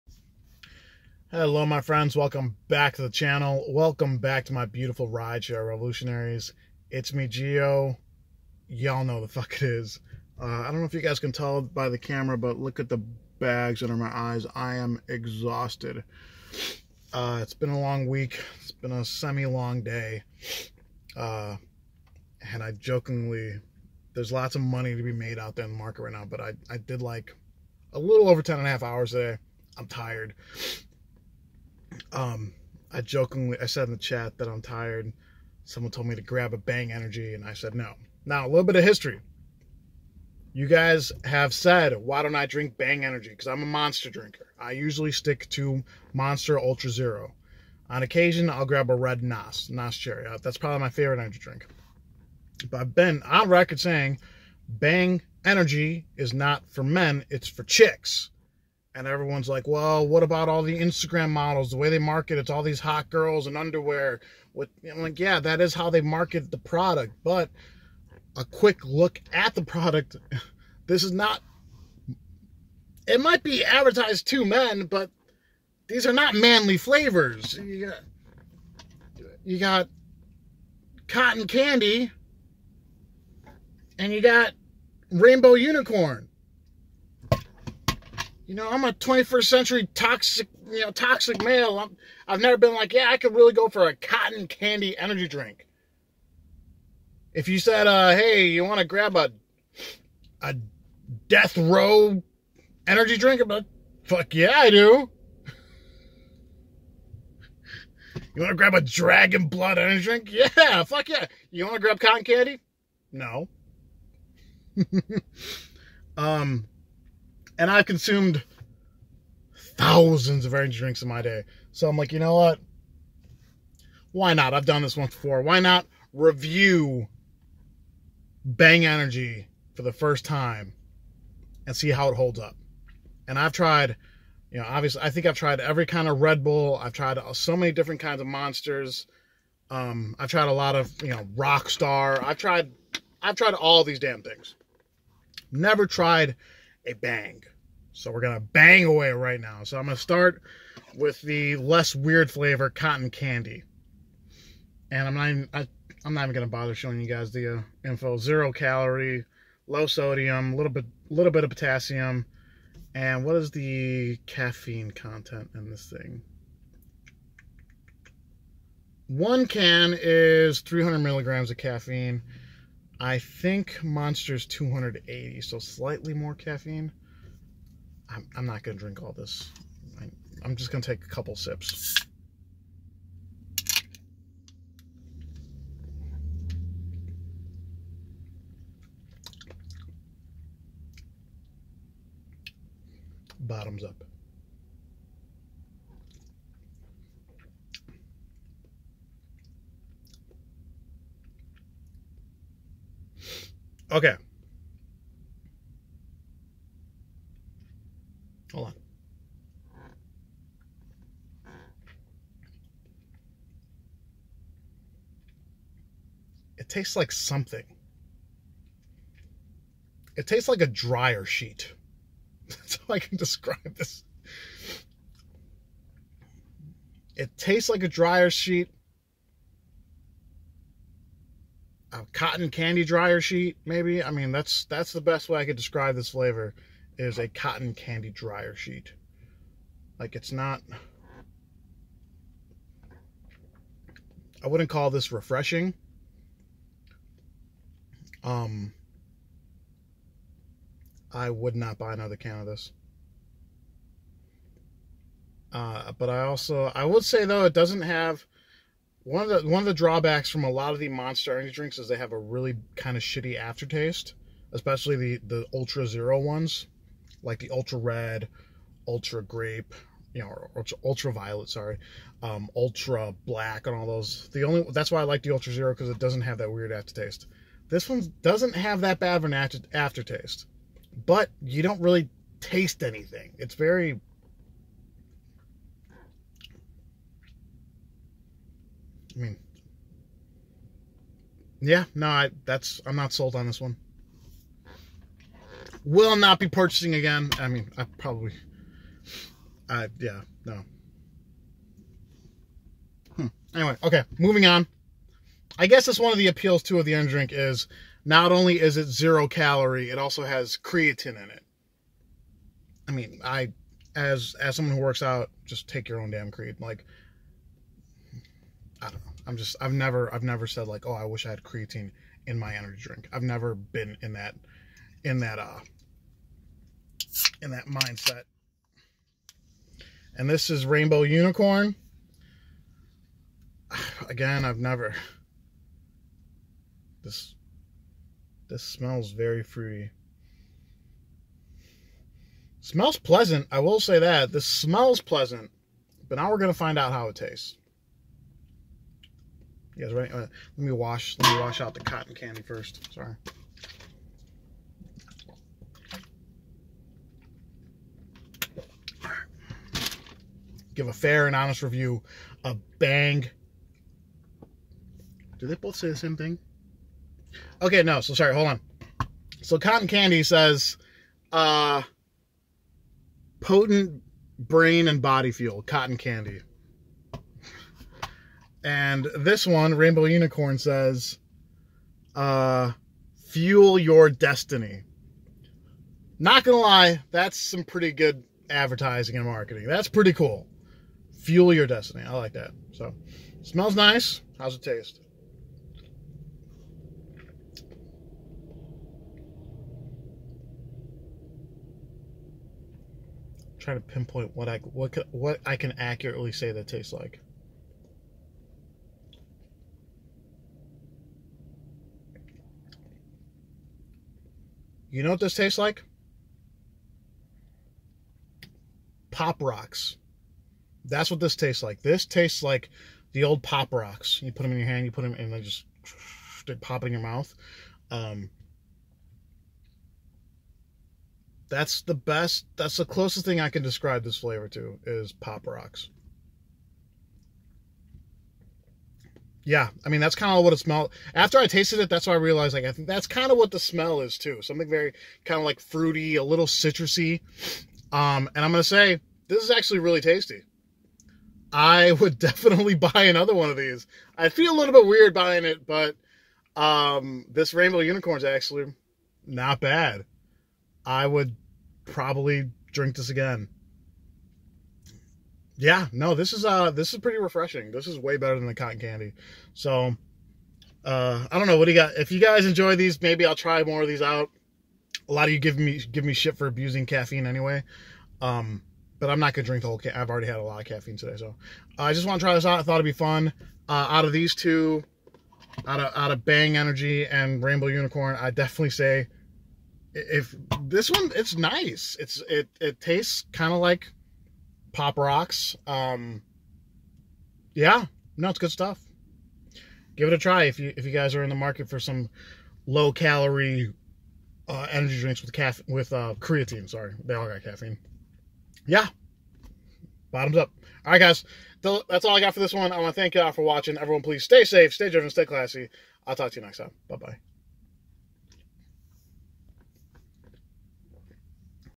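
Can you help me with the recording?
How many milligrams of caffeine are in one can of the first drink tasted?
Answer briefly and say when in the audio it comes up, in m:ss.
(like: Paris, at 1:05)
300, at 2:50.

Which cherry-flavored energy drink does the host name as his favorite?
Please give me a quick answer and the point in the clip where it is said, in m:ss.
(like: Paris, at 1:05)
Nas Cherry, at 0:49.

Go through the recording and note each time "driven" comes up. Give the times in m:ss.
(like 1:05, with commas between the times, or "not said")
8:34.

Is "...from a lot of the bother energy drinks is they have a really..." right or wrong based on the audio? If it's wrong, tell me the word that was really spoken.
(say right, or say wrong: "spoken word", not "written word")
wrong: "monster", not "bother".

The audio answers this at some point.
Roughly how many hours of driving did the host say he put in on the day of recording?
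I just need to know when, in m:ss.
0:28.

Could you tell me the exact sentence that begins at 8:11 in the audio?
It's it it tastes kind of like Pop Rocks.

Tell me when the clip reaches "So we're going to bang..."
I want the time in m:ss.
2:27.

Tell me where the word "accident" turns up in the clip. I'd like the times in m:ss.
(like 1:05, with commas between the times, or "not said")
not said.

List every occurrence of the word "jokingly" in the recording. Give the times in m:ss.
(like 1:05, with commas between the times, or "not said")
0:22, 0:33.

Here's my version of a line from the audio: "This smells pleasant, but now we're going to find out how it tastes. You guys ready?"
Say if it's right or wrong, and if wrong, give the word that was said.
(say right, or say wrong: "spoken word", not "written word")
right.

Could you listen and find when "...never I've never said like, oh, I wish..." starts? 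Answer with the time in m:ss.
5:19.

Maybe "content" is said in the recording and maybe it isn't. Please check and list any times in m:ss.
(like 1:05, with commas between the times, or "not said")
2:44.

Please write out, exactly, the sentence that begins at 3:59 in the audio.
Like it's not, I wouldn't call this refreshing.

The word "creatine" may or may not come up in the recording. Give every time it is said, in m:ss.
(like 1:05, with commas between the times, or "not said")
5:10, 5:16, 5:21, 8:26.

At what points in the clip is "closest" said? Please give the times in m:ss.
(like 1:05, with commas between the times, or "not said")
7:12.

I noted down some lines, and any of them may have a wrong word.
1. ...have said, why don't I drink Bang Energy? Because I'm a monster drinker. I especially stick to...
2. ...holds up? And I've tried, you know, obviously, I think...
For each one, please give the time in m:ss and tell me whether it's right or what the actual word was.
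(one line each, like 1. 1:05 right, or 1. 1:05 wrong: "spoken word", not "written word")
1. 0:41 wrong: "usually", not "especially"
2. 2:12 right.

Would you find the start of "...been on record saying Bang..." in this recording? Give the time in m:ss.
0:52.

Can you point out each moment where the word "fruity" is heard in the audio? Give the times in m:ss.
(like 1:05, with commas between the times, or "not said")
5:39, 7:25.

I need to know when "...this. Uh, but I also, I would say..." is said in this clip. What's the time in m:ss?
4:12.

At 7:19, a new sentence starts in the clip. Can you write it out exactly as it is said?
yeah, I mean that's kind of what it smelled.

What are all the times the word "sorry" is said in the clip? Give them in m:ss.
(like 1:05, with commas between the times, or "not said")
4:31, 5:52, 6:08, 8:26.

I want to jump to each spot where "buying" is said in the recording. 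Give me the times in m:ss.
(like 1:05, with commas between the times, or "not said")
7:35.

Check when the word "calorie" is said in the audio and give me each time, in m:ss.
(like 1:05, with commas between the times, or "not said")
2:38, 5:09, 8:22.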